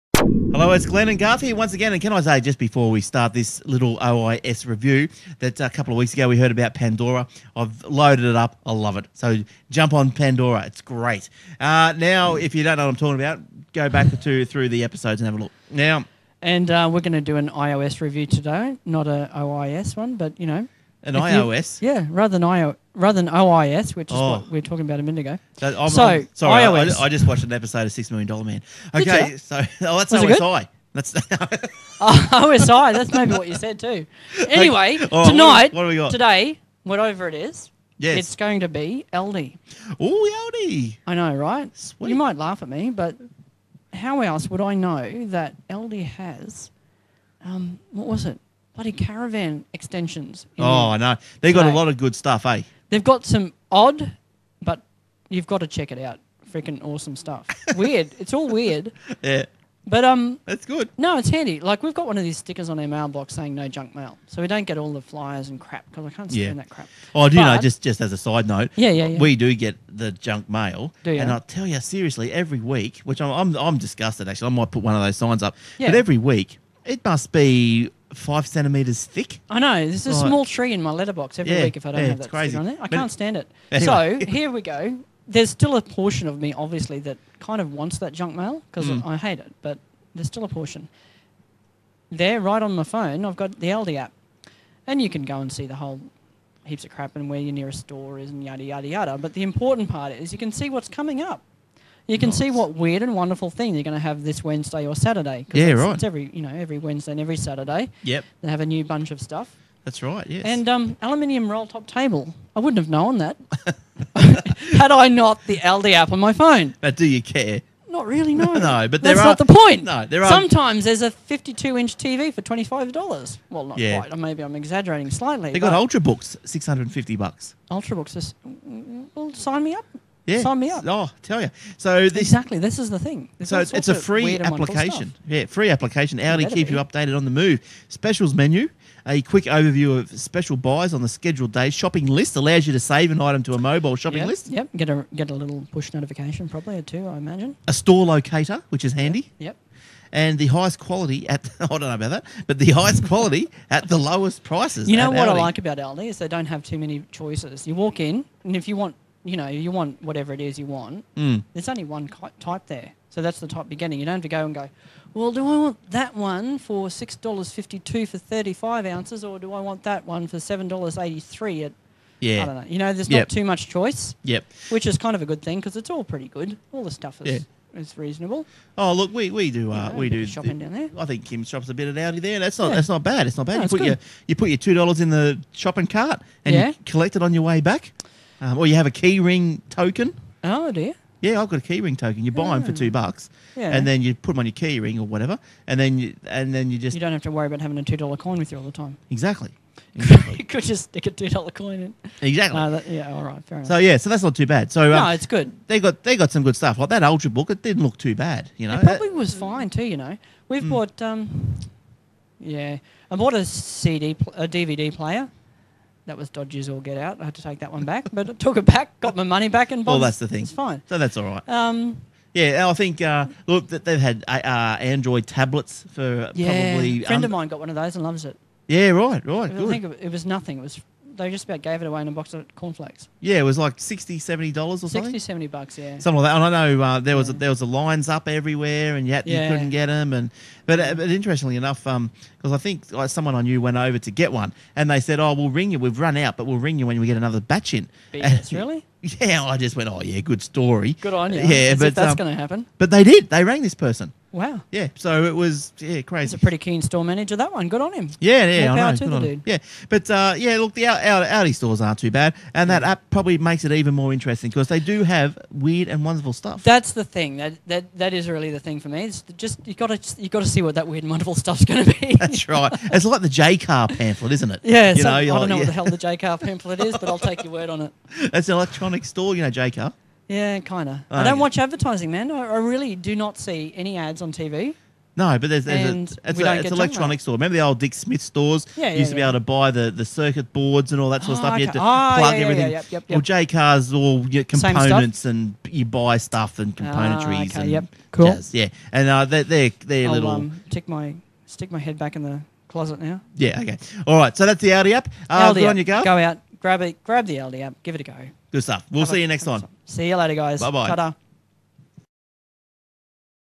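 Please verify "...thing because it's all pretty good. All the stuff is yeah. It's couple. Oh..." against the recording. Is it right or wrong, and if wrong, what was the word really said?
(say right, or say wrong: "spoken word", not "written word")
wrong: "reasonable", not "couple".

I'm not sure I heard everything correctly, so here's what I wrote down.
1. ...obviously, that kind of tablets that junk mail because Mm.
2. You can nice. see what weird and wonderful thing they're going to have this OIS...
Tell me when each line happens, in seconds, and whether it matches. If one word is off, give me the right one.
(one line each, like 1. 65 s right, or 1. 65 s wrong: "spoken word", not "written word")
1. 86 s wrong: "wants", not "tablets"
2. 102 s wrong: "Wednesday", not "OIS".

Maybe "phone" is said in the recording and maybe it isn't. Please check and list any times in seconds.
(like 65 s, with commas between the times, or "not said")
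92 s, 116 s.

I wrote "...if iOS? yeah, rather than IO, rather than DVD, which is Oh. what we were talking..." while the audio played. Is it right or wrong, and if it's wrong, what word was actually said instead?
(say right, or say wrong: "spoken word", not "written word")
wrong: "OIS", not "DVD".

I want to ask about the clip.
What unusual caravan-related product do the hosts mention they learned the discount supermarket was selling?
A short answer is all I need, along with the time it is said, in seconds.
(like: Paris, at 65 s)
caravan extensions, at 48 s.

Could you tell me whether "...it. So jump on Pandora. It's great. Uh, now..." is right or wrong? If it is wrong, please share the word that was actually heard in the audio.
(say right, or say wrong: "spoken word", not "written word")
right.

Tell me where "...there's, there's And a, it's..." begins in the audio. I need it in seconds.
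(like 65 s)
285 s.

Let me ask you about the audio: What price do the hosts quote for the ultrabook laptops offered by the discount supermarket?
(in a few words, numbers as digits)
650 bucks.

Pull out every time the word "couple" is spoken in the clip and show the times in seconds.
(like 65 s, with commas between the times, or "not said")
5 s.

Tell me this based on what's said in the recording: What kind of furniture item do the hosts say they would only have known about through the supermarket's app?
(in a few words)
aluminium roll top table.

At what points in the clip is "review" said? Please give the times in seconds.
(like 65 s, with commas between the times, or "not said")
4 s, 18 s.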